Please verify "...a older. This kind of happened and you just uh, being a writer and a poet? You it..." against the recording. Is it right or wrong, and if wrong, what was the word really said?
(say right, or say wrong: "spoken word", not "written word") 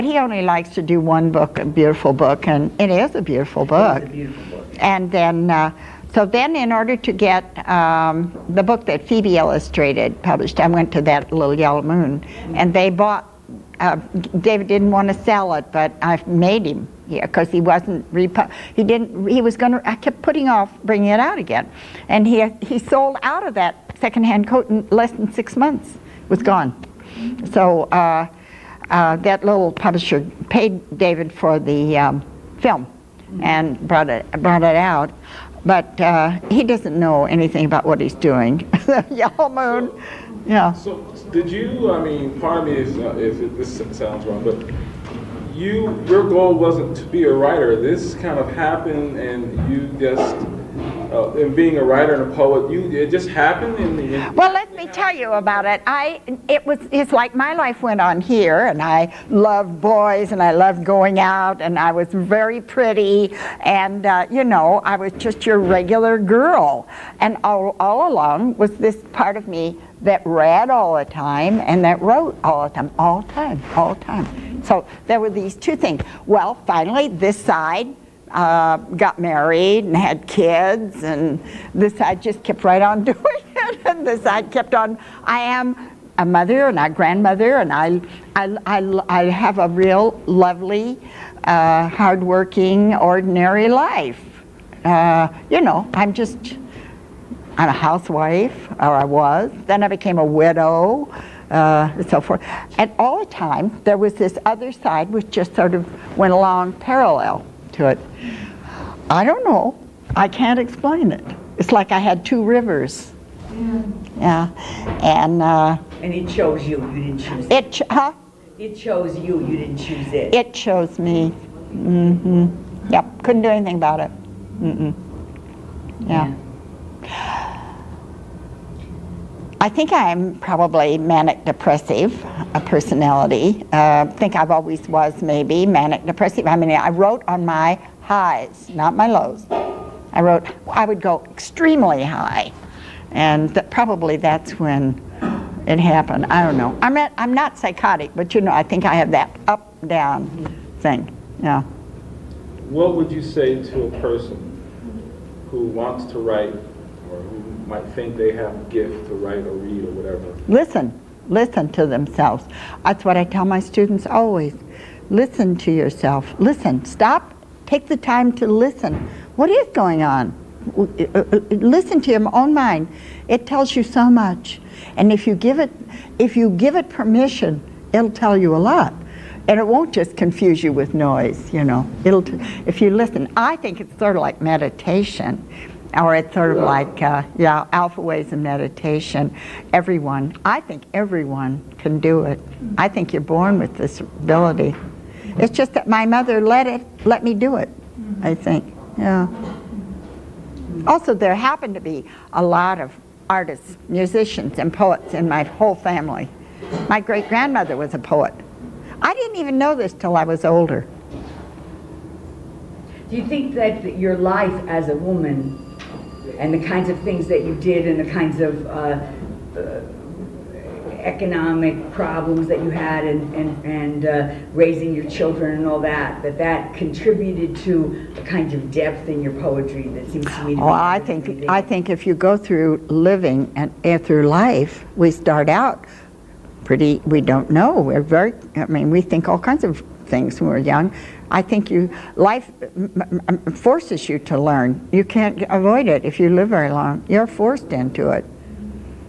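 wrong: "writer", not "older".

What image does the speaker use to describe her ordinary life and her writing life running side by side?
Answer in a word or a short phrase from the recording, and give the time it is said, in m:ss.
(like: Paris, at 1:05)
two rivers, at 1:52.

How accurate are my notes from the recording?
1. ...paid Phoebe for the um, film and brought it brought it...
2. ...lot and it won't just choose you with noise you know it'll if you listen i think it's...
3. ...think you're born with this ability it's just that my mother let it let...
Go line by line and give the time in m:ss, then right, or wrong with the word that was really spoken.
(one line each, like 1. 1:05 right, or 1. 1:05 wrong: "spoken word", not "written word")
1. 0:30 wrong: "David", not "Phoebe"
2. 2:58 wrong: "confuse", not "choose"
3. 3:12 right.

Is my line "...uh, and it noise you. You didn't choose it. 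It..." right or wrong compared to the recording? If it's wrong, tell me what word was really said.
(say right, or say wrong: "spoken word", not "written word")
wrong: "chose", not "noise".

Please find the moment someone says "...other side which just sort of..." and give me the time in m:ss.
1:44.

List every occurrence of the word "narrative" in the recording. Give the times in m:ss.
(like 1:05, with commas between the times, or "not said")
not said.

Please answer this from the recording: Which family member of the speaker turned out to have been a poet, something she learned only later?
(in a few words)
great grandmother.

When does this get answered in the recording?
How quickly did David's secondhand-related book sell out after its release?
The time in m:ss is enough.
0:24.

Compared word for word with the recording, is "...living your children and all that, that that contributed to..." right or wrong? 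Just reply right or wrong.
wrong.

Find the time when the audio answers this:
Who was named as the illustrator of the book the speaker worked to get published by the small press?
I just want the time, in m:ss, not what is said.
0:09.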